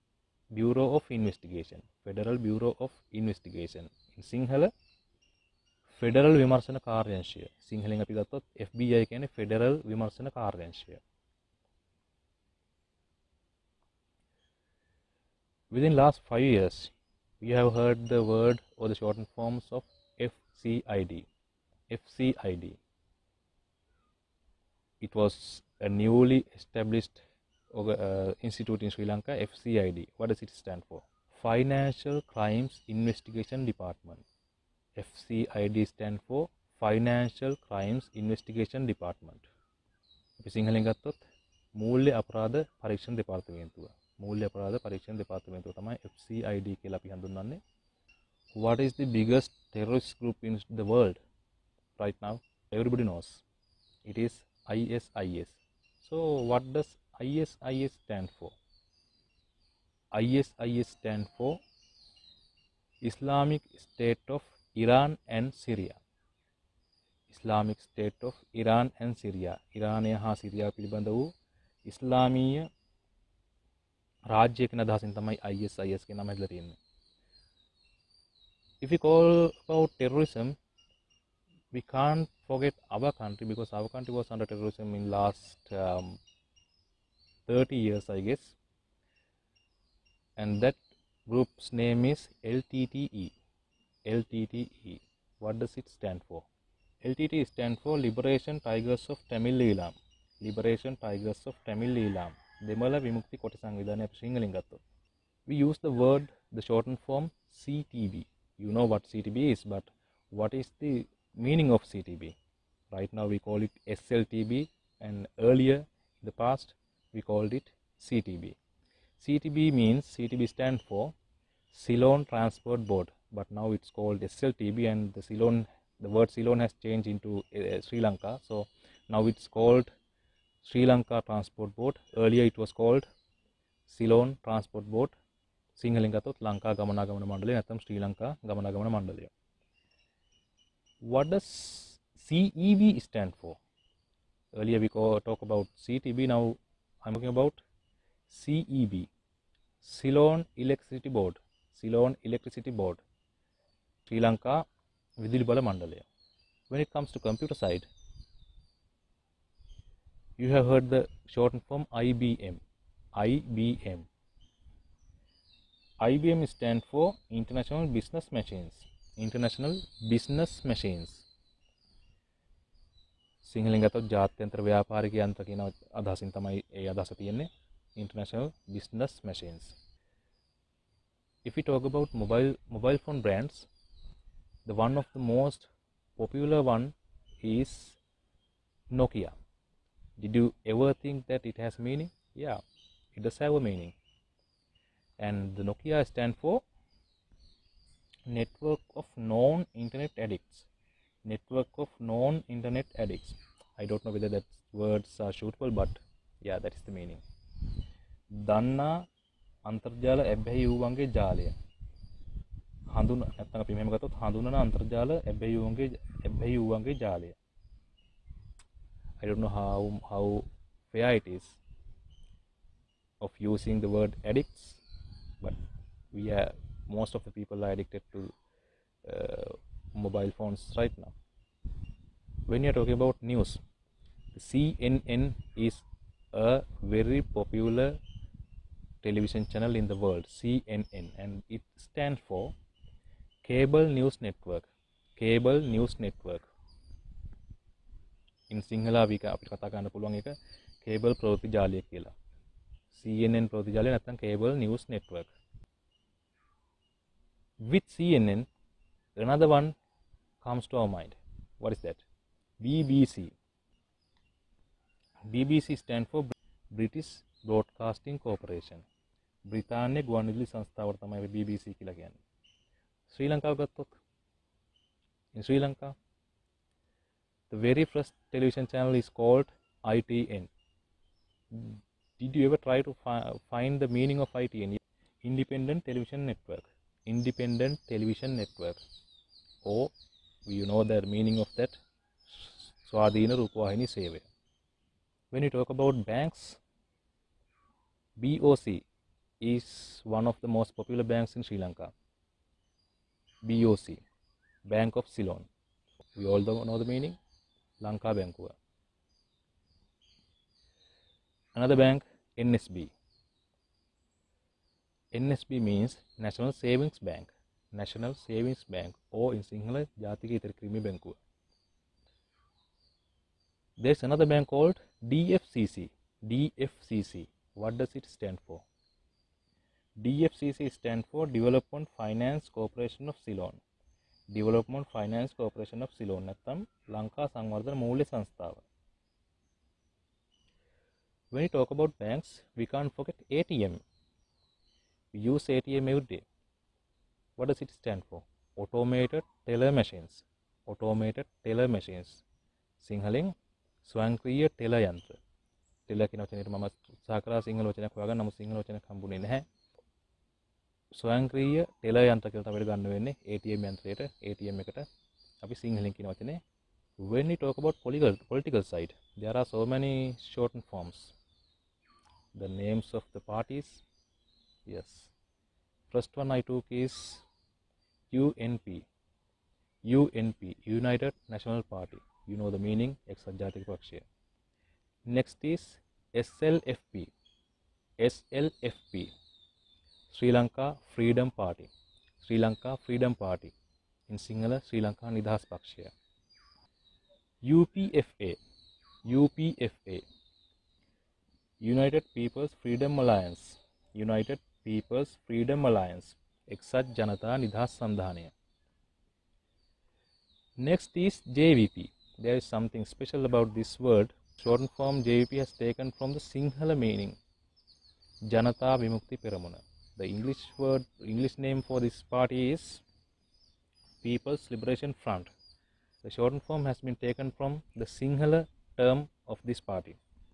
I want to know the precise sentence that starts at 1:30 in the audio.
And that group's name is LTTE.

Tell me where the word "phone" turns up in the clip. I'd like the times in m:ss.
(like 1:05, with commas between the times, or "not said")
3:03, 3:50.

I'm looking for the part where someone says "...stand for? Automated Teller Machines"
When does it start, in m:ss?
5:47.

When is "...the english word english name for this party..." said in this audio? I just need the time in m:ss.
6:59.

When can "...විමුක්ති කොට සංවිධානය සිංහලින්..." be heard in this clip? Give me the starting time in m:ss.
1:43.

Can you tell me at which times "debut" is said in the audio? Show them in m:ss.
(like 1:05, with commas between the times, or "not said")
not said.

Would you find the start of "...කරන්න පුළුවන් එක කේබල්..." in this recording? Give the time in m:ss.
4:09.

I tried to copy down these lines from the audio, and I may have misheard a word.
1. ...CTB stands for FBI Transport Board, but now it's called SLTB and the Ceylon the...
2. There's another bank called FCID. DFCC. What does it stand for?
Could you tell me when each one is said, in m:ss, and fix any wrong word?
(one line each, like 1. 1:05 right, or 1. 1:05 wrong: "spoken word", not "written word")
1. 2:00 wrong: "Ceylon", not "FBI"
2. 5:23 wrong: "DFCC", not "FCID".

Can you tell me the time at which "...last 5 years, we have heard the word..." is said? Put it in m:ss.
0:15.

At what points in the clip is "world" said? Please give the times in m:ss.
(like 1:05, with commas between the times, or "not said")
3:59.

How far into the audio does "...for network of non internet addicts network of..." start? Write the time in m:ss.
3:16.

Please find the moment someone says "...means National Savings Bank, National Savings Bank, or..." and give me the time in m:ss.
5:15.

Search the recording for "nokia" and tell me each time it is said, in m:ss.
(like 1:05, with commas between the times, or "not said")
3:09, 3:15.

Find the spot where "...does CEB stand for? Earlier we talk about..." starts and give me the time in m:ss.
2:21.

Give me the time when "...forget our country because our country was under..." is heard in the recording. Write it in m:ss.
1:22.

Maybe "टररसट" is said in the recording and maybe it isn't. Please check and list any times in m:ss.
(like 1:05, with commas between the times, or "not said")
0:49.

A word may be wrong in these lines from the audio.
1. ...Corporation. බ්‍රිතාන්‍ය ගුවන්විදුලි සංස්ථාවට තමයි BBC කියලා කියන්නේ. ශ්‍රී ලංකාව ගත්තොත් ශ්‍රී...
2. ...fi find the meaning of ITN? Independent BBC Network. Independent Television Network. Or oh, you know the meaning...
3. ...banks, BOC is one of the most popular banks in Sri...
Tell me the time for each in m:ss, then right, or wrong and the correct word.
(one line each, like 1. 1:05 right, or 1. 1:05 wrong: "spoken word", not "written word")
1. 4:28 right
2. 4:43 wrong: "Television", not "BBC"
3. 4:56 right.